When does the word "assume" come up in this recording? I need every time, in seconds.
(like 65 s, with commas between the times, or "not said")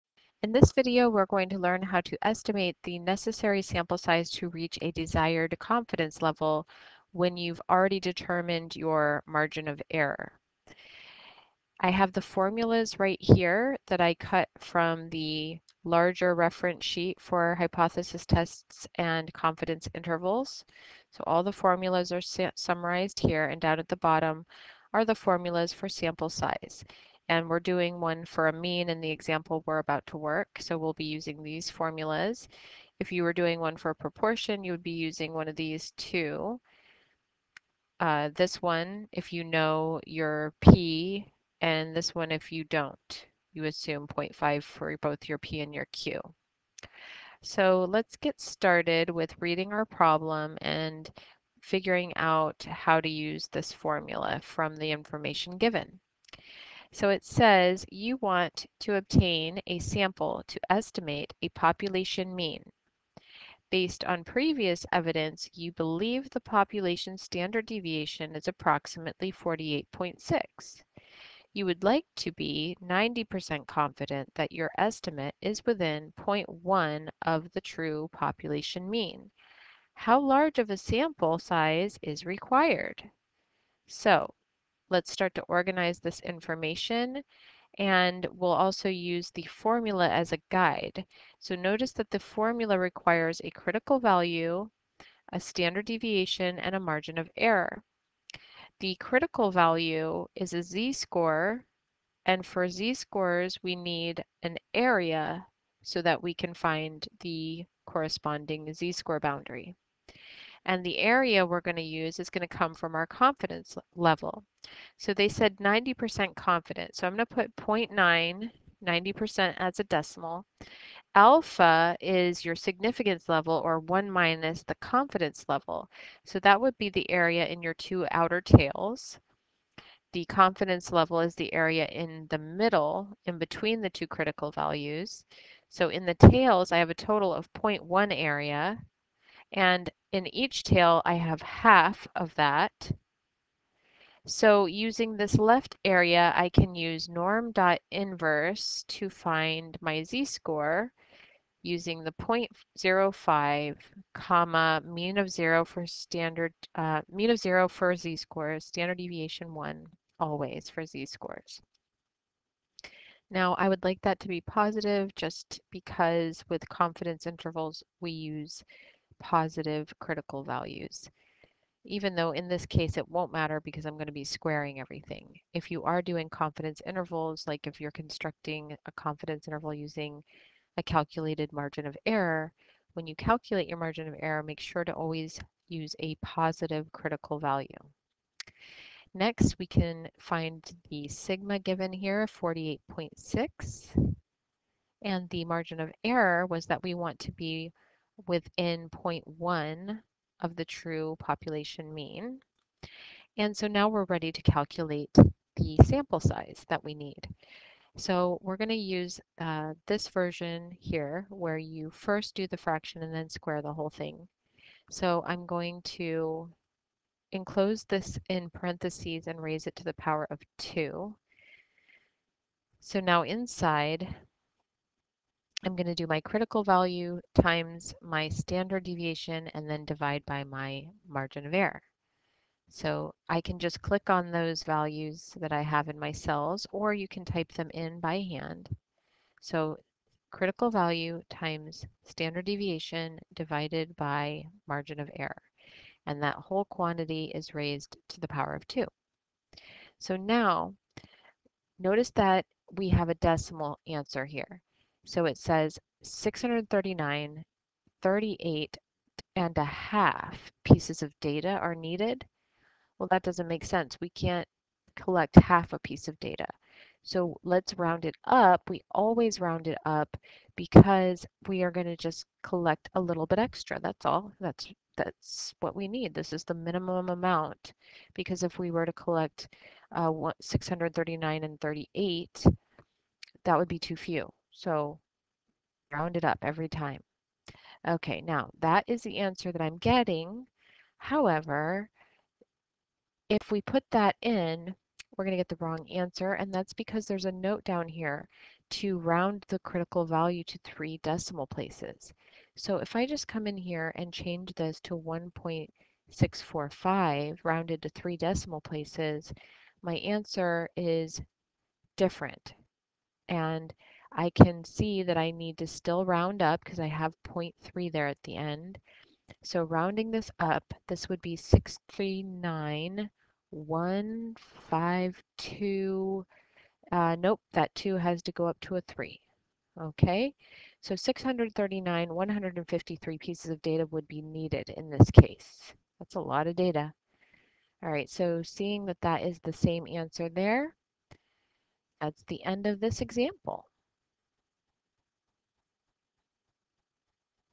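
43 s.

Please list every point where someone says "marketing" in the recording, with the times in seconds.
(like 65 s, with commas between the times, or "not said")
not said.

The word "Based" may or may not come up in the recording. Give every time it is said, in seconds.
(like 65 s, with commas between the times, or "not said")
63 s.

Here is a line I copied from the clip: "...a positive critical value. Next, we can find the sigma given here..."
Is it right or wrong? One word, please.
right.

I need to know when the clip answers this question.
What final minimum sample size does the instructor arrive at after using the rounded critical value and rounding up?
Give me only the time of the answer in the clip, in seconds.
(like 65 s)
330 s.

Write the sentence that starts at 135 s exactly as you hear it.
So in the tails, I have a total of 0.1 area, and in each tail, I have half of that.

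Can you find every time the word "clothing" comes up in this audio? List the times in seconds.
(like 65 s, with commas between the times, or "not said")
not said.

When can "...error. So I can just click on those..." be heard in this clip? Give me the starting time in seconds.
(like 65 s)
231 s.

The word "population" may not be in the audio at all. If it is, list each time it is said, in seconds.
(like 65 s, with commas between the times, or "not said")
61 s, 66 s, 78 s, 201 s.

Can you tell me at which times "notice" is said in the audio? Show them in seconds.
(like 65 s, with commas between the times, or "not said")
91 s, 251 s.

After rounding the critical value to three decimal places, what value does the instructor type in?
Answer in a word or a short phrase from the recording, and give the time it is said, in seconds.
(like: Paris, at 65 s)
1.645, at 304 s.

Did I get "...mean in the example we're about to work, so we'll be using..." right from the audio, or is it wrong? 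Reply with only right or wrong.
right.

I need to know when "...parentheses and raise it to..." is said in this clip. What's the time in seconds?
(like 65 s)
218 s.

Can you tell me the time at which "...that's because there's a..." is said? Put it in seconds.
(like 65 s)
296 s.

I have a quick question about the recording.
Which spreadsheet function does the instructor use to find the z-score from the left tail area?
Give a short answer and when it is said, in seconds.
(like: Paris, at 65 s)
norm.inverse, at 147 s.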